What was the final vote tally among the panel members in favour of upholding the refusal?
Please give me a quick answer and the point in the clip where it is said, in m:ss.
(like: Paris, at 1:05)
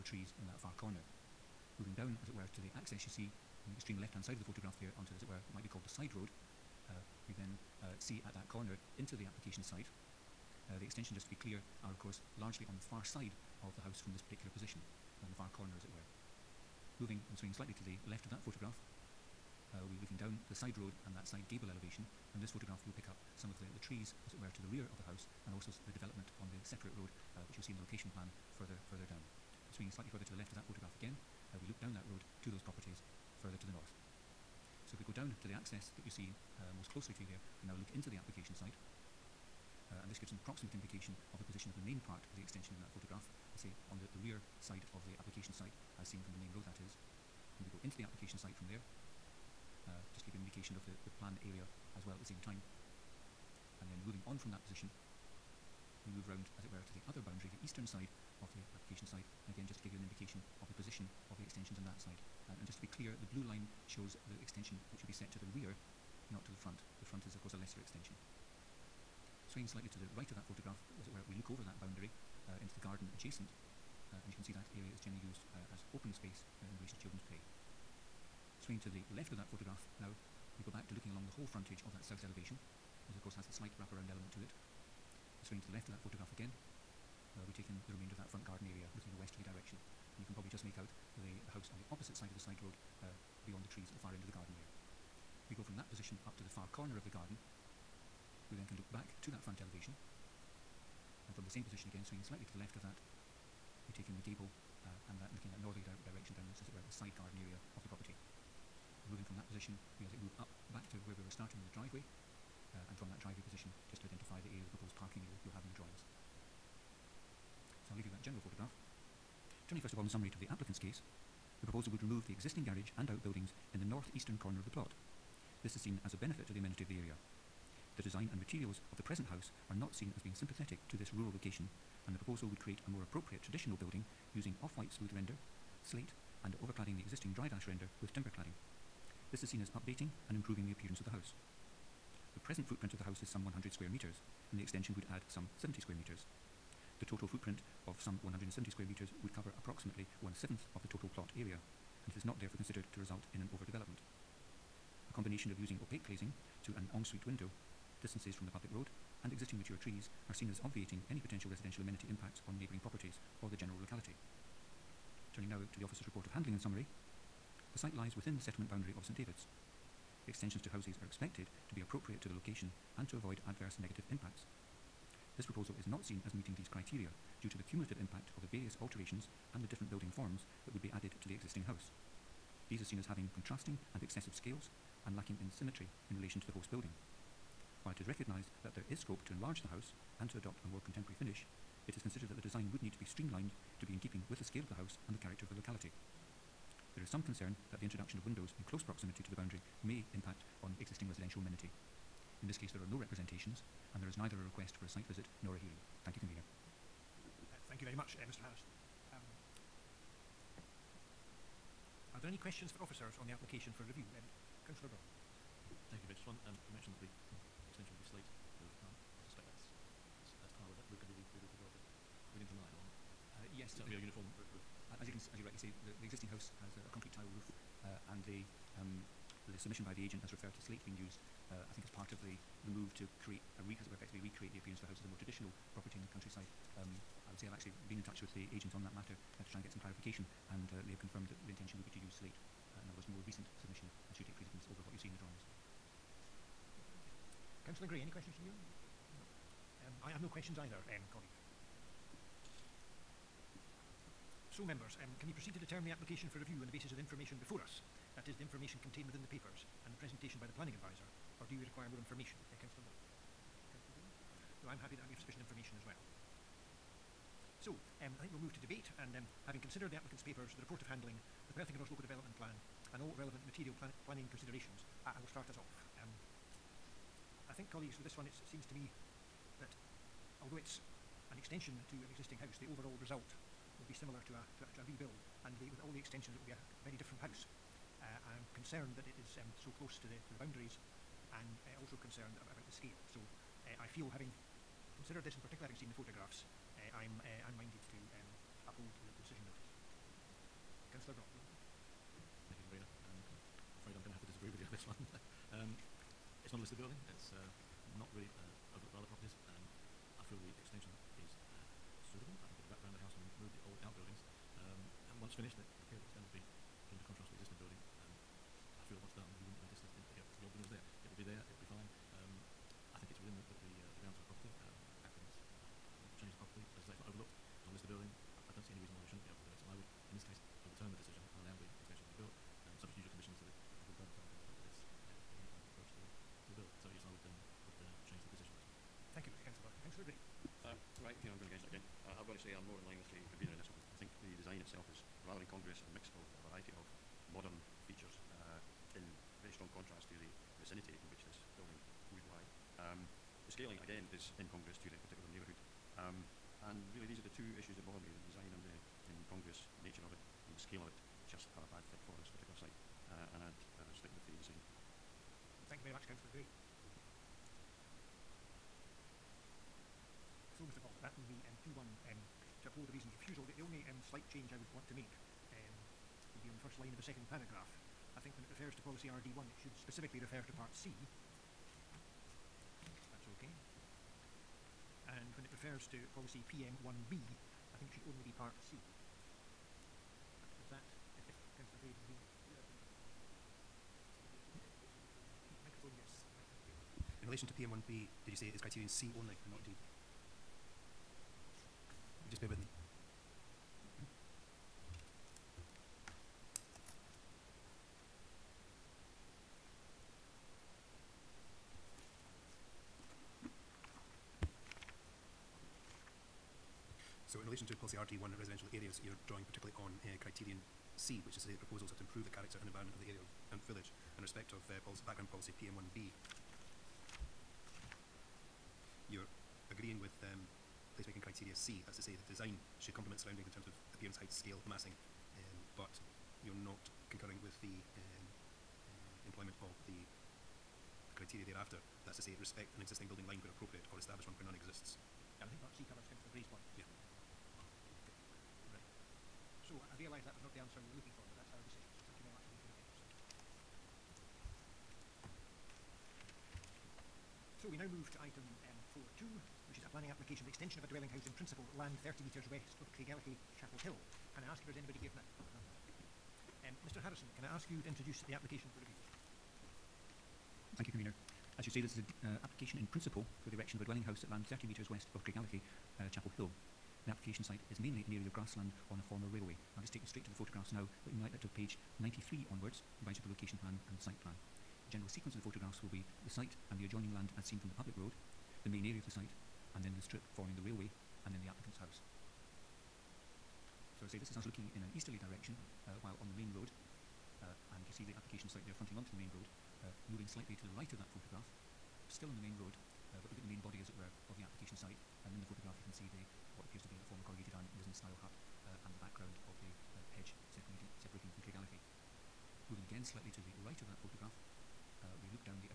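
2-1, at 6:11.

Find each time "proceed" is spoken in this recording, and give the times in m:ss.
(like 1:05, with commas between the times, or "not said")
4:15.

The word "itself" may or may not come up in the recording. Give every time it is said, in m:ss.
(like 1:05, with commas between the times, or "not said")
5:44.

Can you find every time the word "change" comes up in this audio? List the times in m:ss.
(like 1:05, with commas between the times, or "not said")
5:26, 5:38, 6:14.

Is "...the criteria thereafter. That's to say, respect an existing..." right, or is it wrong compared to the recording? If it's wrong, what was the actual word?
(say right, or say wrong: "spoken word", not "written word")
right.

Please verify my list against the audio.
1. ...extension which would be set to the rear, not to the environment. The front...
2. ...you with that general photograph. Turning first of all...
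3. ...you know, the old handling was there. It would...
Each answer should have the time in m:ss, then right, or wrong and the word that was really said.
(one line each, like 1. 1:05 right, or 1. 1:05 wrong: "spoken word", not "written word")
1. 1:04 wrong: "front", not "environment"
2. 1:58 right
3. 5:20 wrong: "building", not "handling".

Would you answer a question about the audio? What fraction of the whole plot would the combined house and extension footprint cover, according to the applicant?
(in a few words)
one-seventh.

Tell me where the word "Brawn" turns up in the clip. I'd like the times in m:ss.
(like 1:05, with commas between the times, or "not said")
3:34, 4:22, 5:39.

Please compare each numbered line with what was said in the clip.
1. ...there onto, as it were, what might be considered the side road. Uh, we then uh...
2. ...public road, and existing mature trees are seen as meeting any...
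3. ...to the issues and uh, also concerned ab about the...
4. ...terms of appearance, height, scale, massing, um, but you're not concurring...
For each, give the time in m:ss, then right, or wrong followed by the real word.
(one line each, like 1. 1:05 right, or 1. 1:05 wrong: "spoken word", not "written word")
1. 0:04 wrong: "called", not "considered"
2. 2:38 wrong: "obviating", not "meeting"
3. 4:50 wrong: "boundaries", not "issues"
4. 7:13 right.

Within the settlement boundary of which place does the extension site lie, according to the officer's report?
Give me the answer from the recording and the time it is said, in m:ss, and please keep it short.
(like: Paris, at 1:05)
St David's, at 2:49.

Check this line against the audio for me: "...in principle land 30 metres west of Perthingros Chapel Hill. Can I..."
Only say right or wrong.
wrong.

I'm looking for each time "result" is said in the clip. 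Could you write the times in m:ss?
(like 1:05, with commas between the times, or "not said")
2:32, 4:42.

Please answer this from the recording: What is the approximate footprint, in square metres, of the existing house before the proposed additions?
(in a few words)
100.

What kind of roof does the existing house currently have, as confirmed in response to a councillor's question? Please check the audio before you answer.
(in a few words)
concrete tile.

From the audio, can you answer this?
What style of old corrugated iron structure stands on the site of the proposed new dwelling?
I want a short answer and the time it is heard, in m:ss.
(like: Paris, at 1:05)
Nissen-style hut, at 8:27.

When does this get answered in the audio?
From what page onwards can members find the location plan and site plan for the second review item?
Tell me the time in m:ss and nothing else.
8:01.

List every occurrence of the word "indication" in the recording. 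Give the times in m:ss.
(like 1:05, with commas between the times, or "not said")
0:40, 0:50, 1:00.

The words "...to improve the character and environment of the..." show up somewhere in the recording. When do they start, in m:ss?
7:01.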